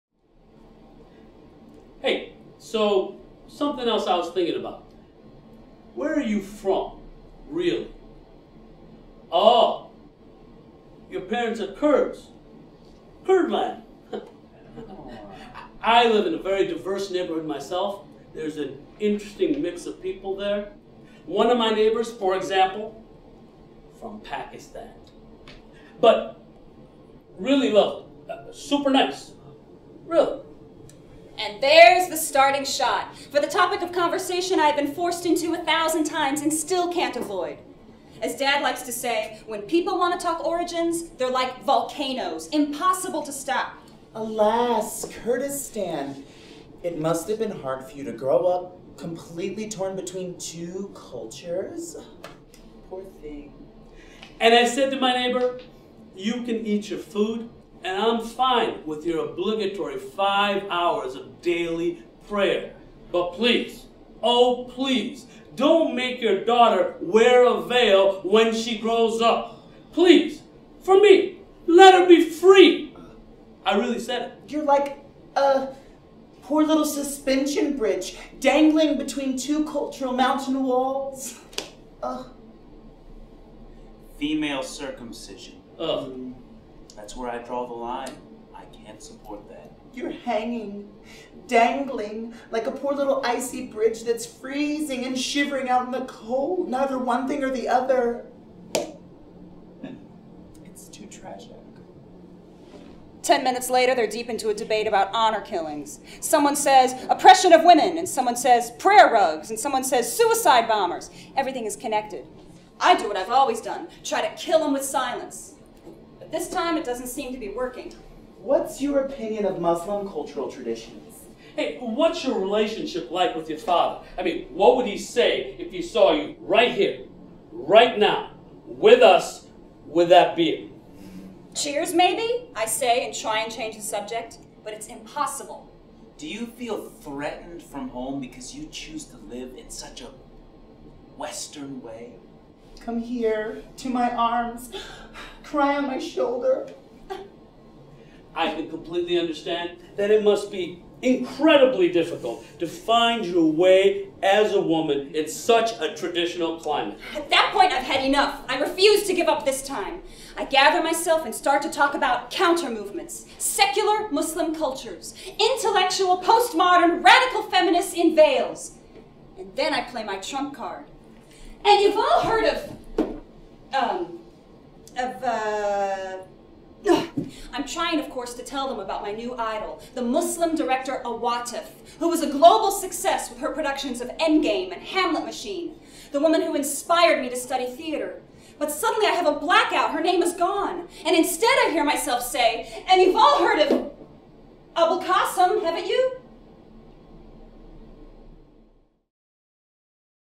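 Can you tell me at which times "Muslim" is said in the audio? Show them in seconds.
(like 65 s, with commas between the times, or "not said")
119 s, 164 s, 180 s.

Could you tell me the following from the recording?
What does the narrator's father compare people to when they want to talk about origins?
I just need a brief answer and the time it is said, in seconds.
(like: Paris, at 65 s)
Volcanoes, at 41 s.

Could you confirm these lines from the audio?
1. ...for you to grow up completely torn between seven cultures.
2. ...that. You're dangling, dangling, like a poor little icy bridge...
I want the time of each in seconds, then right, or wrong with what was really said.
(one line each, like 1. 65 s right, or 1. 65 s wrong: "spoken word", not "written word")
1. 47 s wrong: "two", not "seven"
2. 89 s wrong: "hanging", not "dangling".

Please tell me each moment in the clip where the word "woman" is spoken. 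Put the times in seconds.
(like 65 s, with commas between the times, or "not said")
154 s, 186 s.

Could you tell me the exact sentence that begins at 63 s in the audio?
But please, oh please, don't make your daughter wear a veil when she grows up.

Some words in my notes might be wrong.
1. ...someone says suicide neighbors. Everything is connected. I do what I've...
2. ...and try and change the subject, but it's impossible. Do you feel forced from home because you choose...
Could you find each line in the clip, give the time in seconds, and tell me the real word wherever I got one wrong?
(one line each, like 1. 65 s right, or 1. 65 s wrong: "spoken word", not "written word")
1. 109 s wrong: "bombers", not "neighbors"
2. 133 s wrong: "threatened", not "forced".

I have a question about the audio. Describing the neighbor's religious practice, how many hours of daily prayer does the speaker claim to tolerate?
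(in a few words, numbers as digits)
5.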